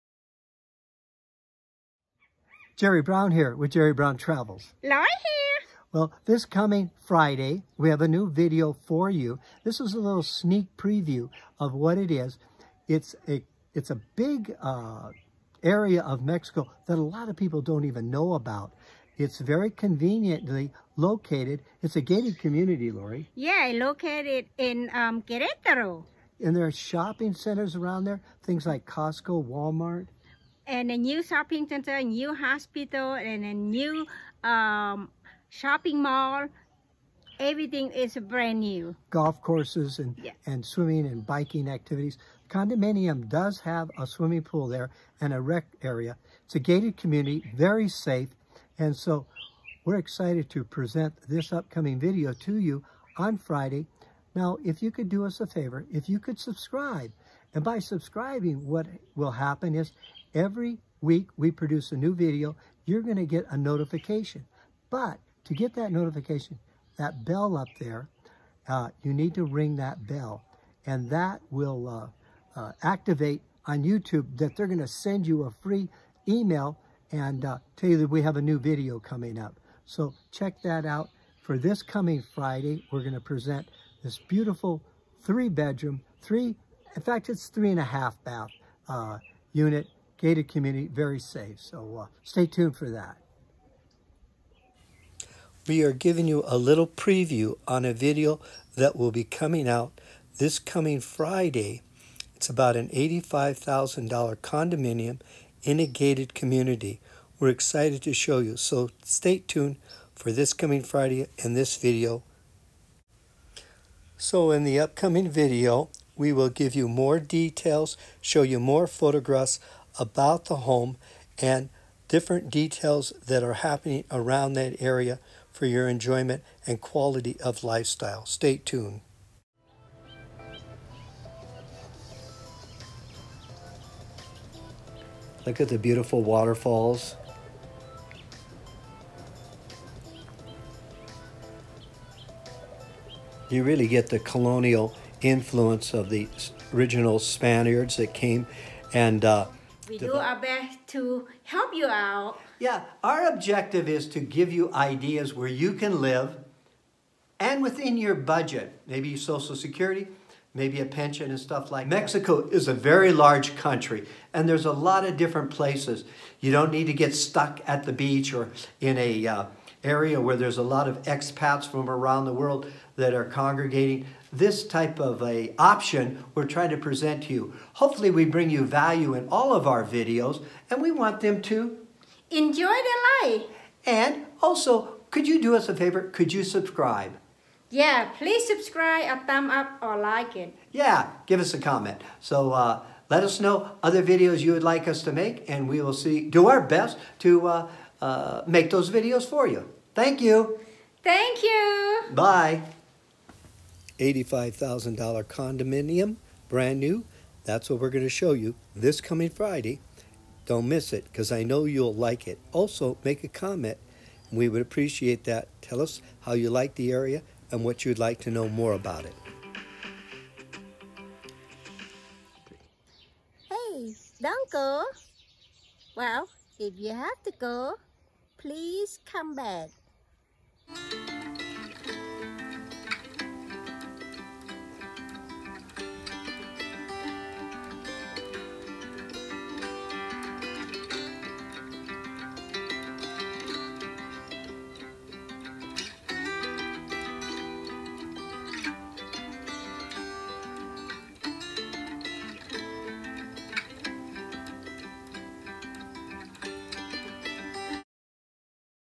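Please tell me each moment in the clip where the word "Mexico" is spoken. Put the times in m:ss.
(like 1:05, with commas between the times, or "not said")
0:16, 2:41.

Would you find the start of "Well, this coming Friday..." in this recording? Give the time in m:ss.
0:05.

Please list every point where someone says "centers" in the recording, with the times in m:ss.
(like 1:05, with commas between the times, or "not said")
0:27, 0:31.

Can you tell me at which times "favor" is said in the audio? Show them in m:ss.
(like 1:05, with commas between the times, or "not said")
0:55, 3:05.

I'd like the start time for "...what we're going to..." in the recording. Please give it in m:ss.
3:27.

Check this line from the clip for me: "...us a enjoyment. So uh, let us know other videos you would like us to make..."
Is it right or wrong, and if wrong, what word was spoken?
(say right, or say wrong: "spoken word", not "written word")
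wrong: "comment", not "enjoyment".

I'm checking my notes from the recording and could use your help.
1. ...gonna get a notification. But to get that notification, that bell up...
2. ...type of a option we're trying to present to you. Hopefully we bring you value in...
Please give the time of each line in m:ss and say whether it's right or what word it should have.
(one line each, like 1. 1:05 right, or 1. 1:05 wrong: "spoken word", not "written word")
1. 1:03 right
2. 2:54 right.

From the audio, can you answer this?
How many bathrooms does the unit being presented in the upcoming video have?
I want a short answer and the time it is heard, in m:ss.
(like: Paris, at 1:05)
3.5, at 1:27.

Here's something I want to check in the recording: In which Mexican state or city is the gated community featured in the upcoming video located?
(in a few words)
Querétaro.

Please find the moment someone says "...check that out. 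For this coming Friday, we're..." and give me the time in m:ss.
1:20.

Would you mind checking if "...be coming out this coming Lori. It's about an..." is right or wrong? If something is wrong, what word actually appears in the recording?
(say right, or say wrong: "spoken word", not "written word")
wrong: "Friday", not "Lori".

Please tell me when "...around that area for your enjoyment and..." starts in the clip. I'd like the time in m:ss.
2:04.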